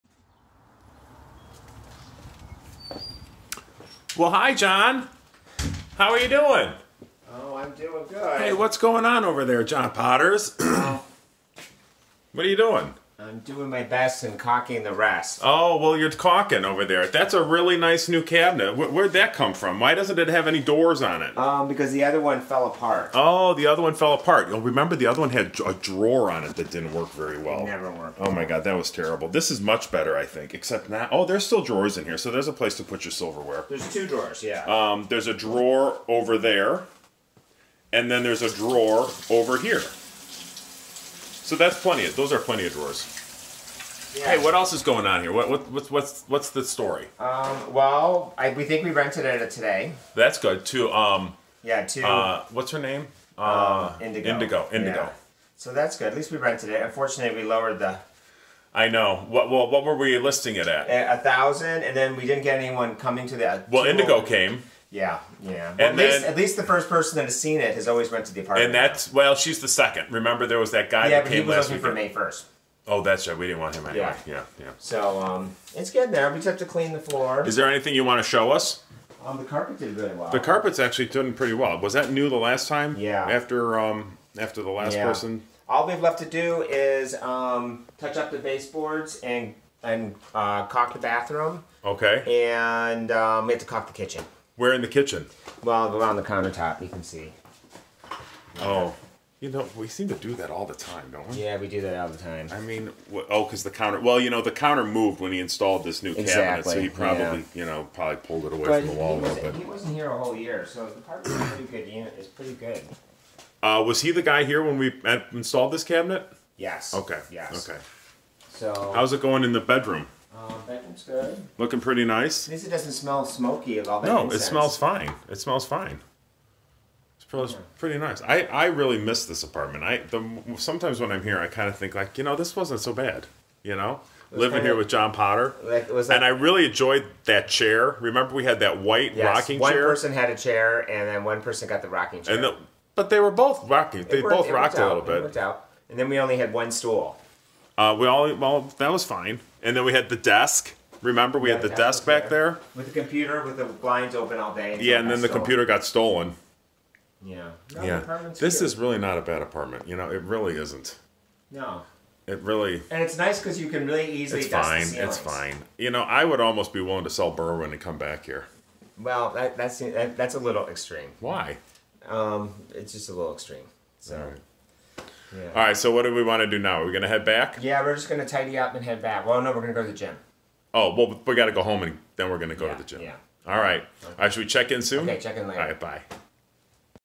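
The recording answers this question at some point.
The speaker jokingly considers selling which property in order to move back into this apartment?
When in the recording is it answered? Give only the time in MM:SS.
02:47.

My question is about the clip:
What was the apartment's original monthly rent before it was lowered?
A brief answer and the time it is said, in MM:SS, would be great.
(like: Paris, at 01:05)
1000, at 01:01.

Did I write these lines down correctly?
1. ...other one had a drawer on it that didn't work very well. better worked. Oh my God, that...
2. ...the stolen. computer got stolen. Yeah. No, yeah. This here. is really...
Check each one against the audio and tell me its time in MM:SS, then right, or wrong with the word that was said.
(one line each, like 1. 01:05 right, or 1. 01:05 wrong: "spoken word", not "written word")
1. 00:25 wrong: "never", not "better"
2. 02:35 right.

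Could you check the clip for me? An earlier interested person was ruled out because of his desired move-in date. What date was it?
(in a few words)
May 1.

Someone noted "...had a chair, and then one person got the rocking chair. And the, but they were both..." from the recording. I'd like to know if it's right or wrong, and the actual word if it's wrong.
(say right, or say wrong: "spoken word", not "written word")
right.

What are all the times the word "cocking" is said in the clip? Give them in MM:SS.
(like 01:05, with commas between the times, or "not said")
00:14.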